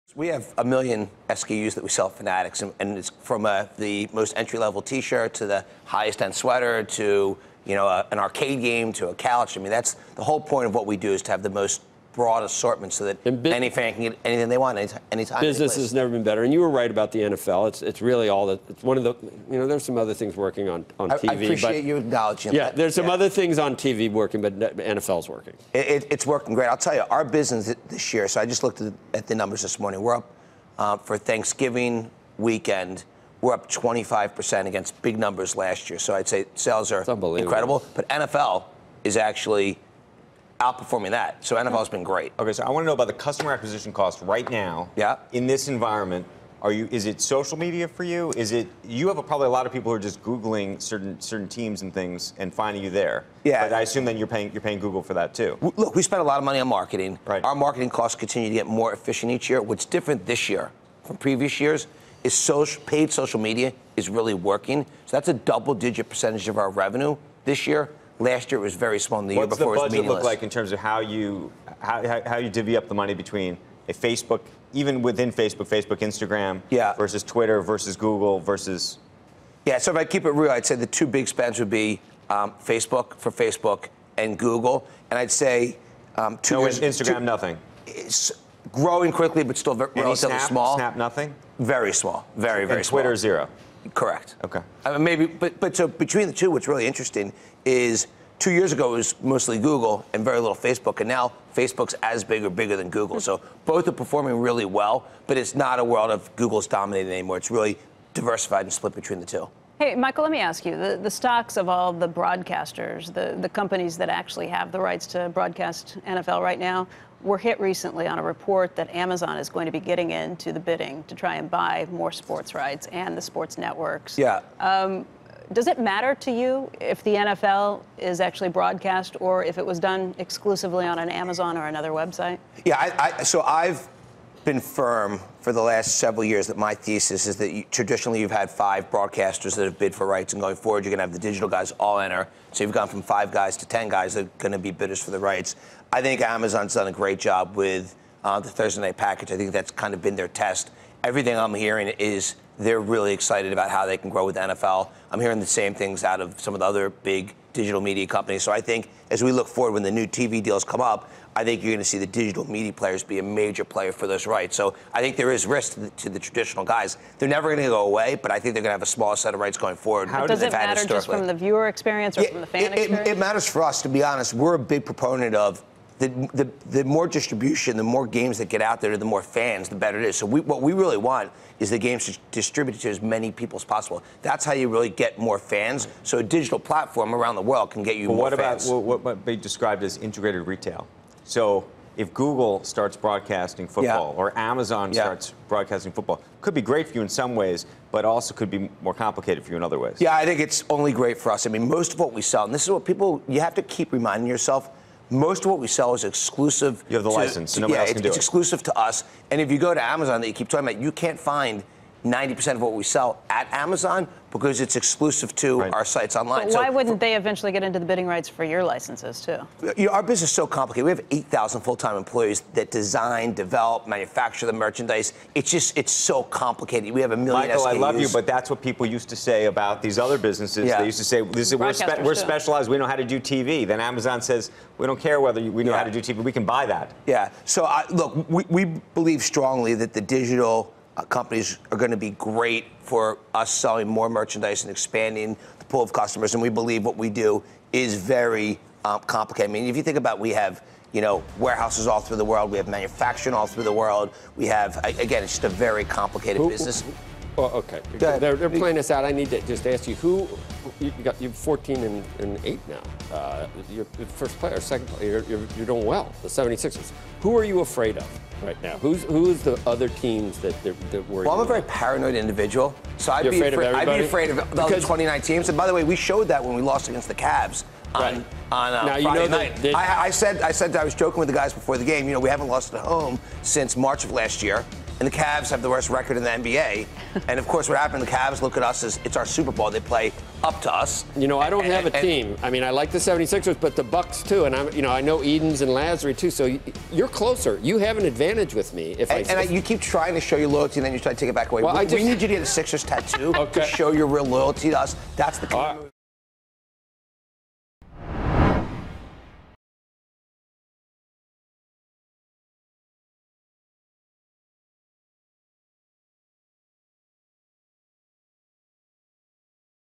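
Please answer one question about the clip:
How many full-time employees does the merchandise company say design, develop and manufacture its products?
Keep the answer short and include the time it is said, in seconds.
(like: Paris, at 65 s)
8,000, at 221 s.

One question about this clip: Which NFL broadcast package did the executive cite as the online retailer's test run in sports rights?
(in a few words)
Thursday night package.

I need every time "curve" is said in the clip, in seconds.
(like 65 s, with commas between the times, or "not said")
not said.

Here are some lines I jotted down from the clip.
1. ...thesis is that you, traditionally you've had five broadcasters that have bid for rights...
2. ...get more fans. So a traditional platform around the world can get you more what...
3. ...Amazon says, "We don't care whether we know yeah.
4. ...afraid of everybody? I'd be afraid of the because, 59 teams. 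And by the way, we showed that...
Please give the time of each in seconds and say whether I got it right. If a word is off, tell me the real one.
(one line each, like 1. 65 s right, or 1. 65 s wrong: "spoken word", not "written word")
1. 136 s right
2. 184 s wrong: "digital", not "traditional"
3. 233 s right
4. 273 s wrong: "29", not "59".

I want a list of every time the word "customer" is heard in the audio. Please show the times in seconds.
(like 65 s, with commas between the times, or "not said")
43 s, 245 s.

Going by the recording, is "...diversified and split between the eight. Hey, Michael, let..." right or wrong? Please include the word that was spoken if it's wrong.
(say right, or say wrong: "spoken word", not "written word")
wrong: "two", not "eight".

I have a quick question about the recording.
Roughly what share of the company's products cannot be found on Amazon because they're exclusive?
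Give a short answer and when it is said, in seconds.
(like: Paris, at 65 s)
90%, at 212 s.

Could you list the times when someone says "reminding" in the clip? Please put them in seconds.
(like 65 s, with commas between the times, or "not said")
203 s.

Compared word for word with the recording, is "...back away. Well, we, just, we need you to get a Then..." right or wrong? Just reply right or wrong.
wrong.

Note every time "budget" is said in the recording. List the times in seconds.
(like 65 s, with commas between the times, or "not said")
69 s.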